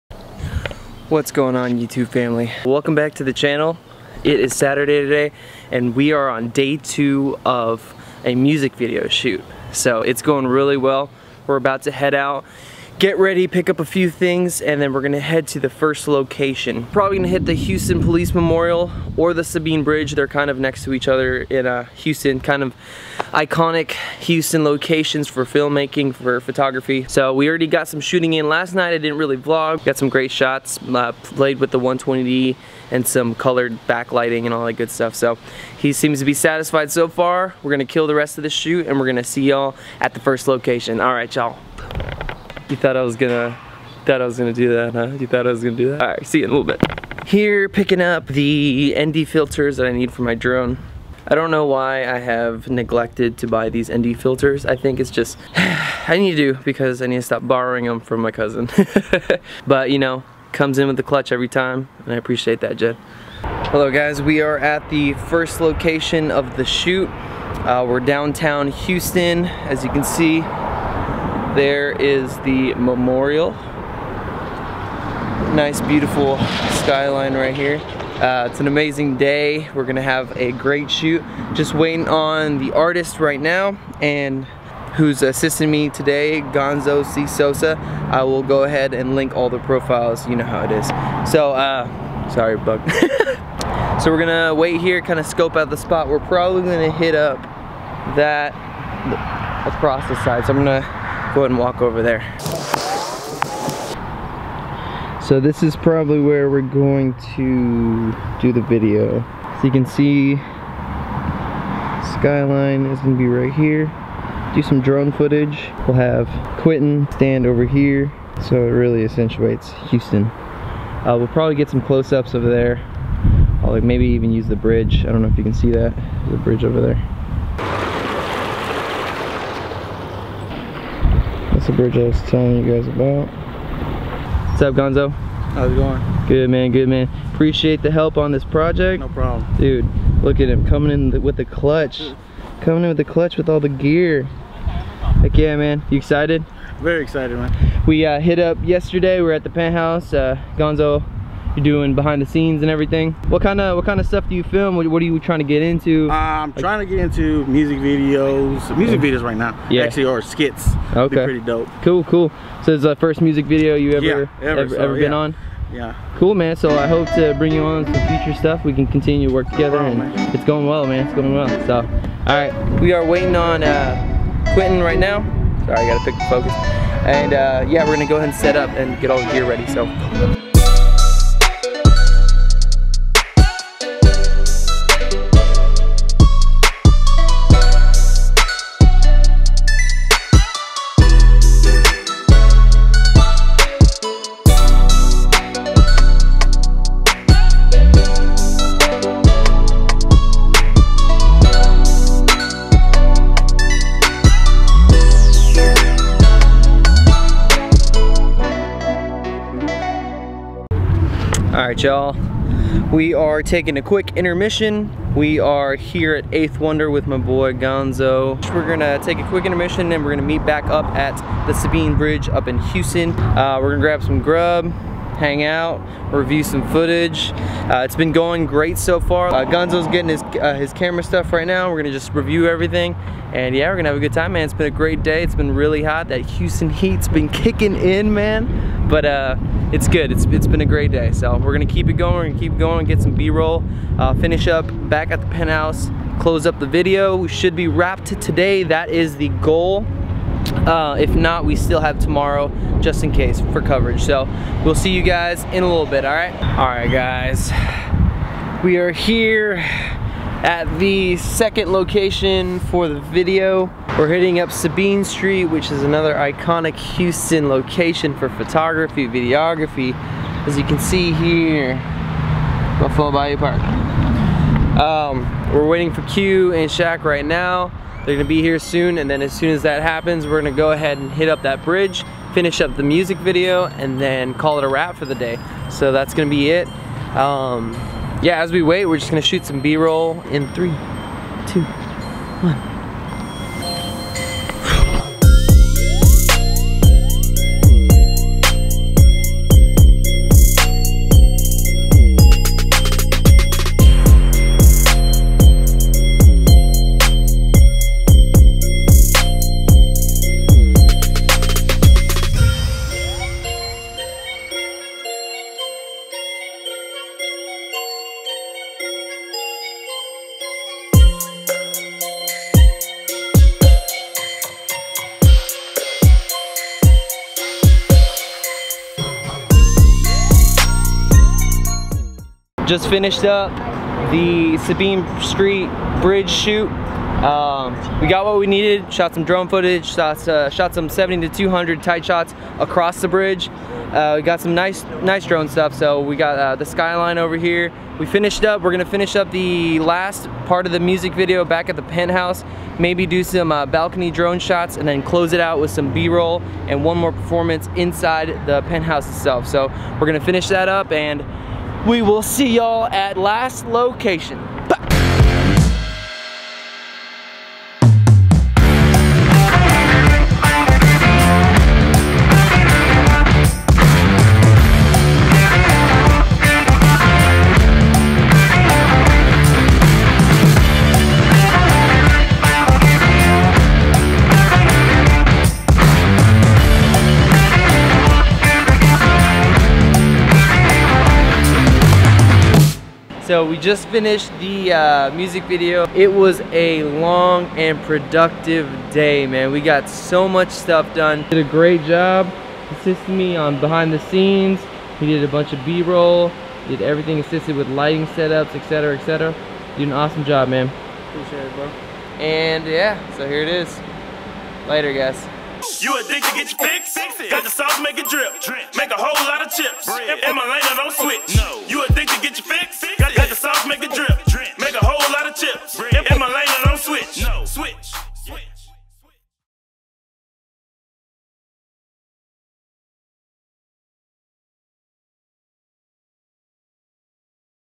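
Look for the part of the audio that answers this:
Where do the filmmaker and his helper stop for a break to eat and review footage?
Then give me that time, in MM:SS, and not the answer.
03:36.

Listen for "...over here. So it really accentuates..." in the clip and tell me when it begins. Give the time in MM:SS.
01:57.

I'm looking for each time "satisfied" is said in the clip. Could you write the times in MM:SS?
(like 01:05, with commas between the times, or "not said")
00:36.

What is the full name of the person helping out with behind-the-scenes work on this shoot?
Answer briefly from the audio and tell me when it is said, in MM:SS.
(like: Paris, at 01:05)
Gonzo C. Sosa, at 01:26.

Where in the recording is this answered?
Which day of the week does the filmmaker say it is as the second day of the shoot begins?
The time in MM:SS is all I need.
00:04.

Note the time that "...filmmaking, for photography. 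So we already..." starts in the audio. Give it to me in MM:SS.
00:25.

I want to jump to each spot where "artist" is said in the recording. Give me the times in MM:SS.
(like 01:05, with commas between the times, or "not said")
01:22.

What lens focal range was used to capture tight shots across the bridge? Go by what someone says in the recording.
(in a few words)
70 to 200.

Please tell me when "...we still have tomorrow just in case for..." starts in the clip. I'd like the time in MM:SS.
04:11.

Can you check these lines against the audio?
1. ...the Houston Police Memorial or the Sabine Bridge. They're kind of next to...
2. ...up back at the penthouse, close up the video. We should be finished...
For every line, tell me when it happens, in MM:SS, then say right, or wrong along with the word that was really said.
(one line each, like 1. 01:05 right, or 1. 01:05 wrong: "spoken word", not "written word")
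1. 00:17 right
2. 04:04 wrong: "wrapped", not "finished".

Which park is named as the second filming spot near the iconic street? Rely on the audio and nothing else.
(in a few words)
Buffalo Bayou Park.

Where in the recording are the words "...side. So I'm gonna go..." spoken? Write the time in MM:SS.
01:40.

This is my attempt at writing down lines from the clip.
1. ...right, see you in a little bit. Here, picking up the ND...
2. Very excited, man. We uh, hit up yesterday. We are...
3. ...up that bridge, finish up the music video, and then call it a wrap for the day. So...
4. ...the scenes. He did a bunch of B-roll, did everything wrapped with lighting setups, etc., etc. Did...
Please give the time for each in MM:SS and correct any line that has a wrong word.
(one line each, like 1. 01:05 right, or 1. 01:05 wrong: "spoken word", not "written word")
1. 00:46 right
2. 02:26 right
3. 04:41 right
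4. 06:43 wrong: "assisted", not "wrapped".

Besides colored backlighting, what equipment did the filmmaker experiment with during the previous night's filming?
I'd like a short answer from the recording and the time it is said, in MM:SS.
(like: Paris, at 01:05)
120D, at 00:31.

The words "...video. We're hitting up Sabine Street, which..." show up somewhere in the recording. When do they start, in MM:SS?
04:22.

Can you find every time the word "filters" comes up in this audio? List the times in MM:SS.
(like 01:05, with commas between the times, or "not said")
00:49, 00:54.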